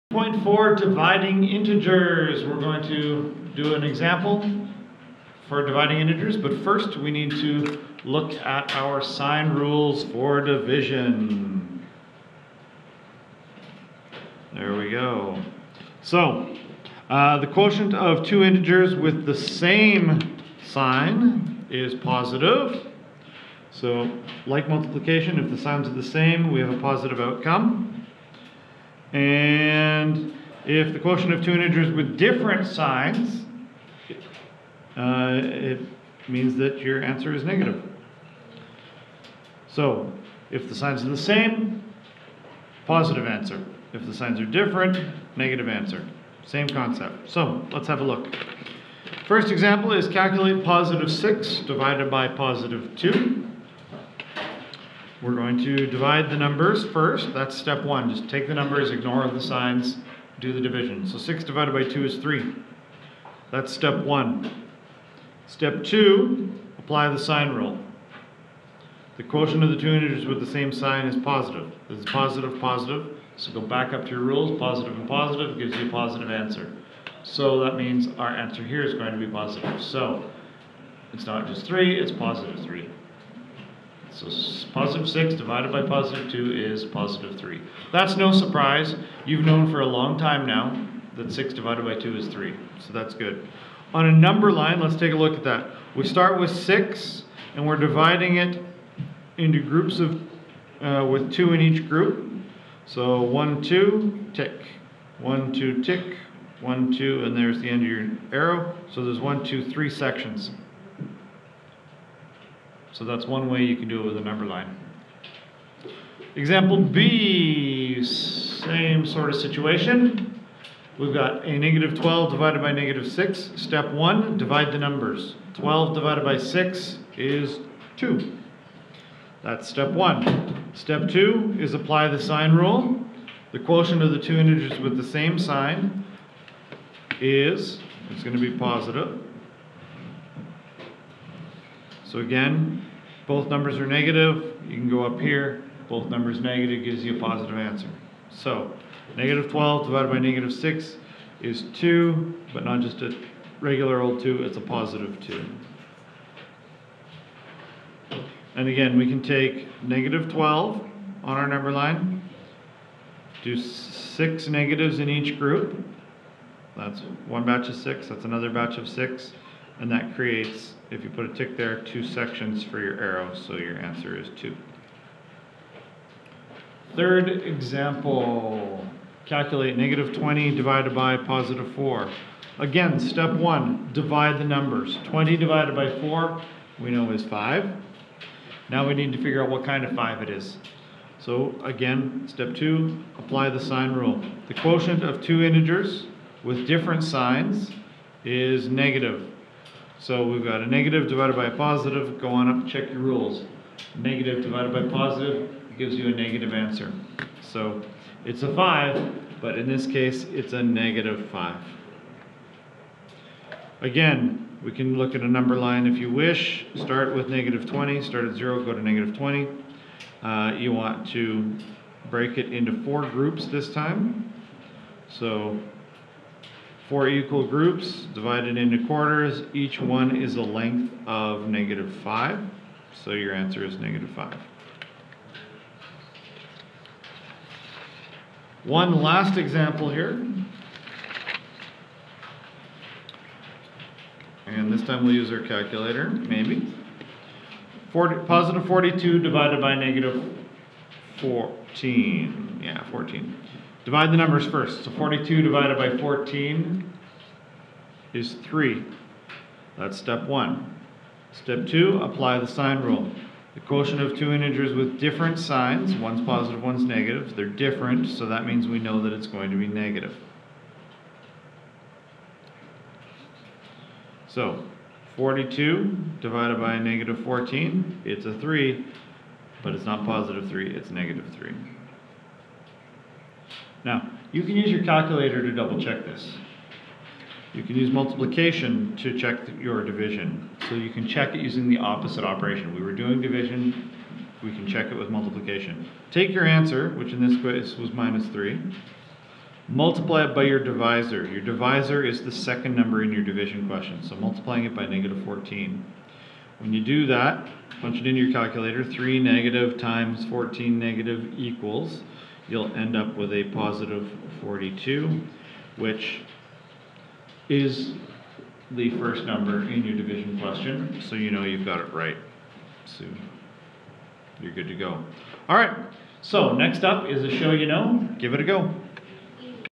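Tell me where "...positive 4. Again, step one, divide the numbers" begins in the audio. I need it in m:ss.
3:01.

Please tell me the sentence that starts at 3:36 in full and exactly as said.
Start with negative 20, start at 0, go to negative 20.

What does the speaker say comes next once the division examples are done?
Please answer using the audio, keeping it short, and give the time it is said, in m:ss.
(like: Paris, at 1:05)
a show you know, at 5:27.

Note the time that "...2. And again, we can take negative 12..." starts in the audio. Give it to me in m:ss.
2:35.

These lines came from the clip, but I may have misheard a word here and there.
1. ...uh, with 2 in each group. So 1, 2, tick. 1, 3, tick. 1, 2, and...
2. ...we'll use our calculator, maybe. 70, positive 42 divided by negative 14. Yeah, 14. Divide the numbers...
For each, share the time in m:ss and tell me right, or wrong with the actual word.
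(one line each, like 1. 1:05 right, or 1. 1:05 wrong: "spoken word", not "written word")
1. 1:40 wrong: "2", not "3"
2. 4:05 wrong: "40", not "70".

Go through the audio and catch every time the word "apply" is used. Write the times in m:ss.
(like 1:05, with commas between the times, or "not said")
1:06, 2:11, 3:13, 4:22.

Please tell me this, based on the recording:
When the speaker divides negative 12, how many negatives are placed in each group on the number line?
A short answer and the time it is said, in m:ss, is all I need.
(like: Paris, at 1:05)
6, at 2:43.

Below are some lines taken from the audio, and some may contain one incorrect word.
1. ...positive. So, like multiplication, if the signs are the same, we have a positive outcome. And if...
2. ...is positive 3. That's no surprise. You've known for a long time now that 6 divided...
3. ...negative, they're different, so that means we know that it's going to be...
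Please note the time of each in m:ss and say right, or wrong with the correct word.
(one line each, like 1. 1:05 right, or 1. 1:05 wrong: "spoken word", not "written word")
1. 0:21 right
2. 1:26 right
3. 4:26 right.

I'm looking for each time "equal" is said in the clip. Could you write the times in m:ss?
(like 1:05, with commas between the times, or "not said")
3:47, 5:11.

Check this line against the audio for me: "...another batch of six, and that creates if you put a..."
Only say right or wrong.
right.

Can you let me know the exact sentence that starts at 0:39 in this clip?
So if the signs are the same, positive answer.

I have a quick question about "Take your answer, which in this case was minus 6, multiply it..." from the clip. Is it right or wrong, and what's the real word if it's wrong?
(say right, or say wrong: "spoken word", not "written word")
wrong: "3", not "6".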